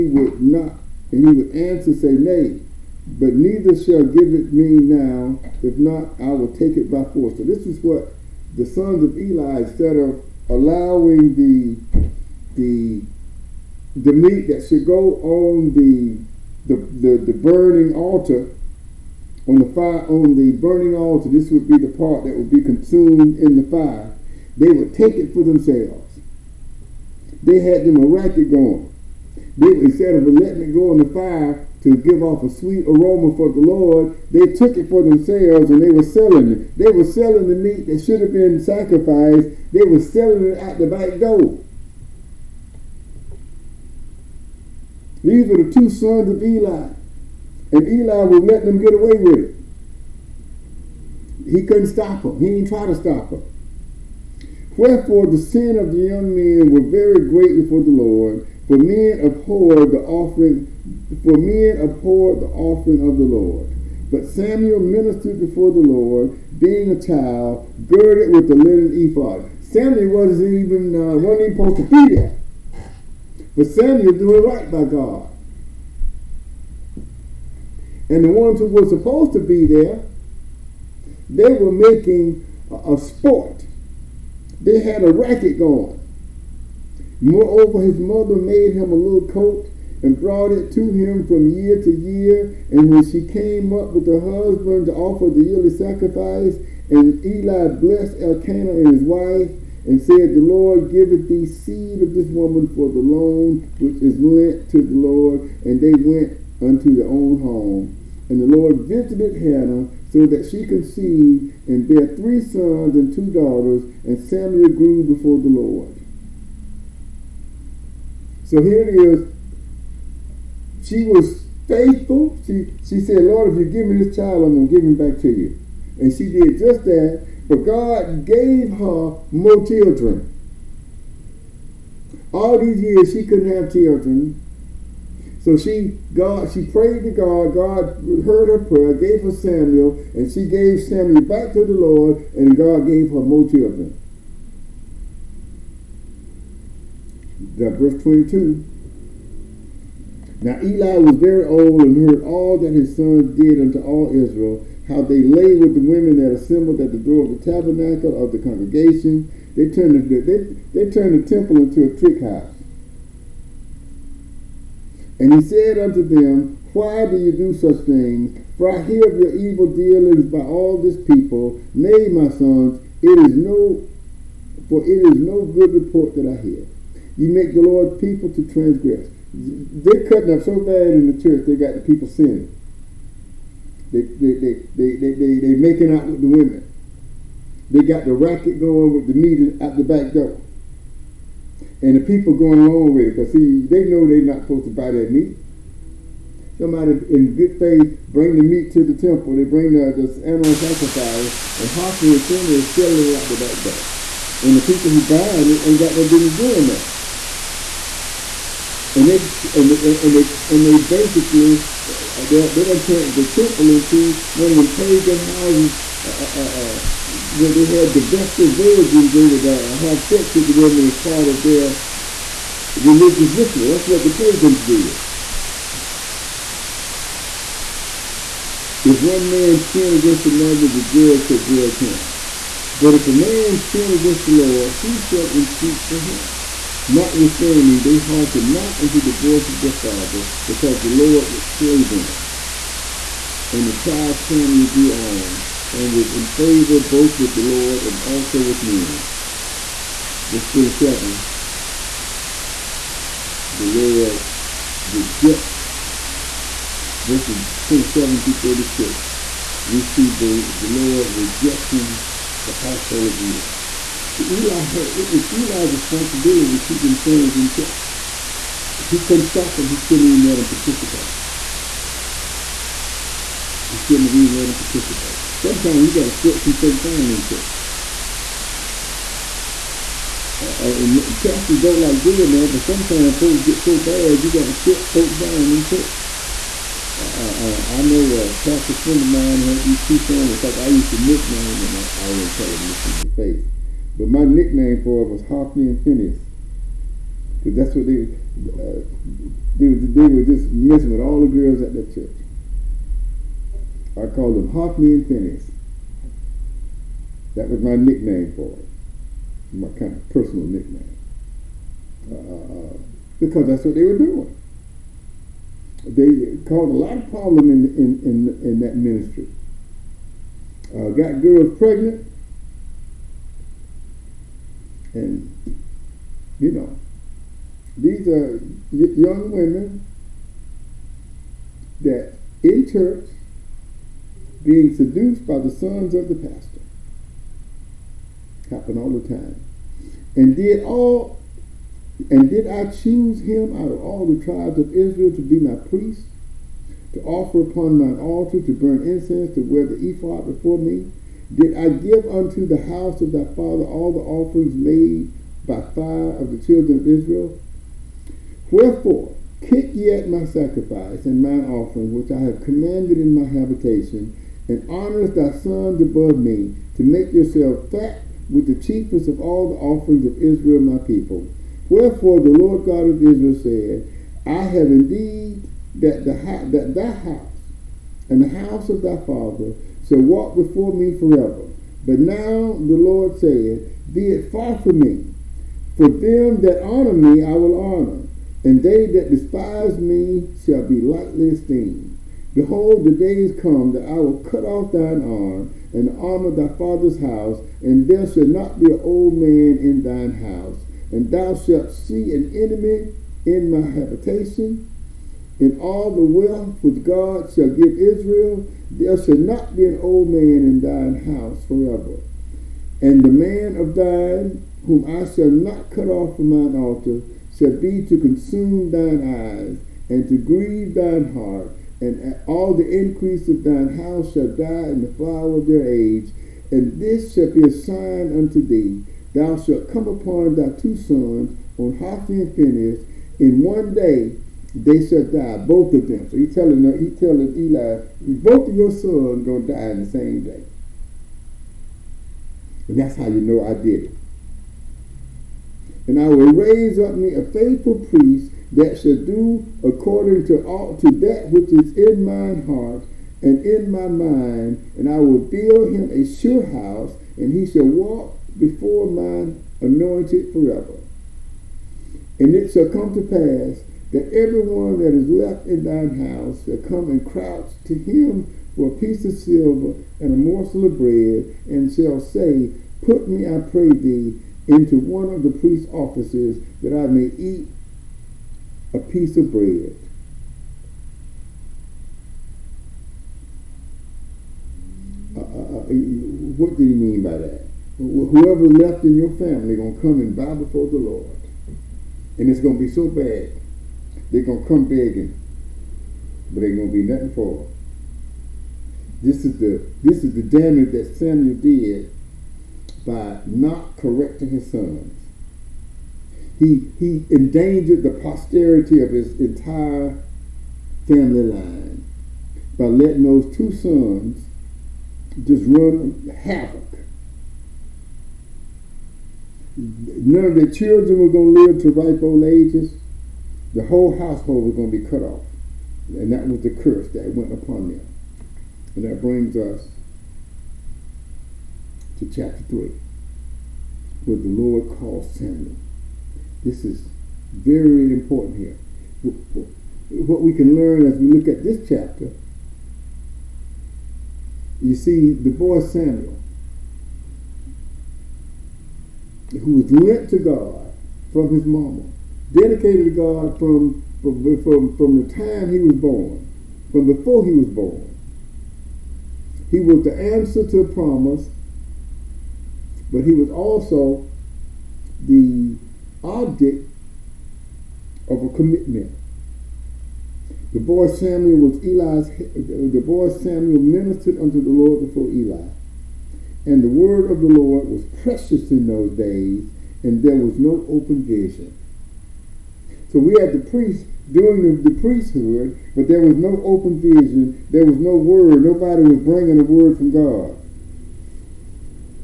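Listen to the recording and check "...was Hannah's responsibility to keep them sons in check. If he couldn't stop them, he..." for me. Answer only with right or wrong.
wrong.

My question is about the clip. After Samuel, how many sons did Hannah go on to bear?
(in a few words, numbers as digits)
3.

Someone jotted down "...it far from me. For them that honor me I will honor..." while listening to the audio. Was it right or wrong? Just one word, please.
right.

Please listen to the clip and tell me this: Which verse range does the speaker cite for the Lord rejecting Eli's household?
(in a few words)
27 through 36.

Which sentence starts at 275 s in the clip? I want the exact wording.
Sometimes you got to set some folk down in church.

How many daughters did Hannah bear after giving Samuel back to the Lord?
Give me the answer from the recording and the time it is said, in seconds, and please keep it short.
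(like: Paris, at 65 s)
2, at 113 s.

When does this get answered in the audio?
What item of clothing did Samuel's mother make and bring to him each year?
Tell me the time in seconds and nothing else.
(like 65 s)
88 s.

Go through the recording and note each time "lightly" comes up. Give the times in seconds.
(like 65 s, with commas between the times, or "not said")
390 s.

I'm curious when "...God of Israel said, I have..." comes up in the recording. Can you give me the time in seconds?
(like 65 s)
372 s.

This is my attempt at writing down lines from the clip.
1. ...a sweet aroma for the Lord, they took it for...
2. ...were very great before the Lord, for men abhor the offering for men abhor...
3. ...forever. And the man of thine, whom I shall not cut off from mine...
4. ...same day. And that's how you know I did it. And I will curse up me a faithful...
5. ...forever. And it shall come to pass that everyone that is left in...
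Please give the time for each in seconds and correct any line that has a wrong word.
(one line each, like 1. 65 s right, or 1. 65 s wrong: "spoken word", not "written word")
1. 32 s right
2. 56 s right
3. 411 s right
4. 439 s wrong: "raise", not "curse"
5. 460 s right.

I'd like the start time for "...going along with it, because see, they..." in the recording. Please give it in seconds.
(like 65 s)
192 s.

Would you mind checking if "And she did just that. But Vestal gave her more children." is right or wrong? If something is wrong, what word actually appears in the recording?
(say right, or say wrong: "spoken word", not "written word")
wrong: "God", not "Vestal".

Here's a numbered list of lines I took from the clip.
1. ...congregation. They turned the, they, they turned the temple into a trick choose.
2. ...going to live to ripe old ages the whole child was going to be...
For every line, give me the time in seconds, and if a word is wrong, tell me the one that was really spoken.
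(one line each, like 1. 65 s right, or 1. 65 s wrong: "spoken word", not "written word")
1. 158 s wrong: "house", not "choose"
2. 521 s wrong: "household", not "child".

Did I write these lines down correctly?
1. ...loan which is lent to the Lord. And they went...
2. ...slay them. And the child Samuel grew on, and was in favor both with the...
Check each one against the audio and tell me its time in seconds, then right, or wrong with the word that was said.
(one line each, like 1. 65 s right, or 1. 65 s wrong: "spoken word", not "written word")
1. 102 s right
2. 241 s right.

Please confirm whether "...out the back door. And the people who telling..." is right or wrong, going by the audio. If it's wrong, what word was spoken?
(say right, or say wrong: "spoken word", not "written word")
wrong: "buying", not "telling".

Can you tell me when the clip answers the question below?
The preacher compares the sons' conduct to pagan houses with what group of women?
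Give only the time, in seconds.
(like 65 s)
218 s.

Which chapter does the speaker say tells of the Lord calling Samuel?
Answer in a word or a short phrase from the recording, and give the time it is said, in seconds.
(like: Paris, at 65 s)
Chapter 3, at 532 s.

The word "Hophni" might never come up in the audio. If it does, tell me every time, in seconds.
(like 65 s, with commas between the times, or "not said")
201 s, 295 s, 304 s, 431 s.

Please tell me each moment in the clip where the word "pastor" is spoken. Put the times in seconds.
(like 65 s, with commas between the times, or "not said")
281 s, 288 s, 336 s.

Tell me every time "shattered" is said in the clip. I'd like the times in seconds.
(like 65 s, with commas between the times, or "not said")
not said.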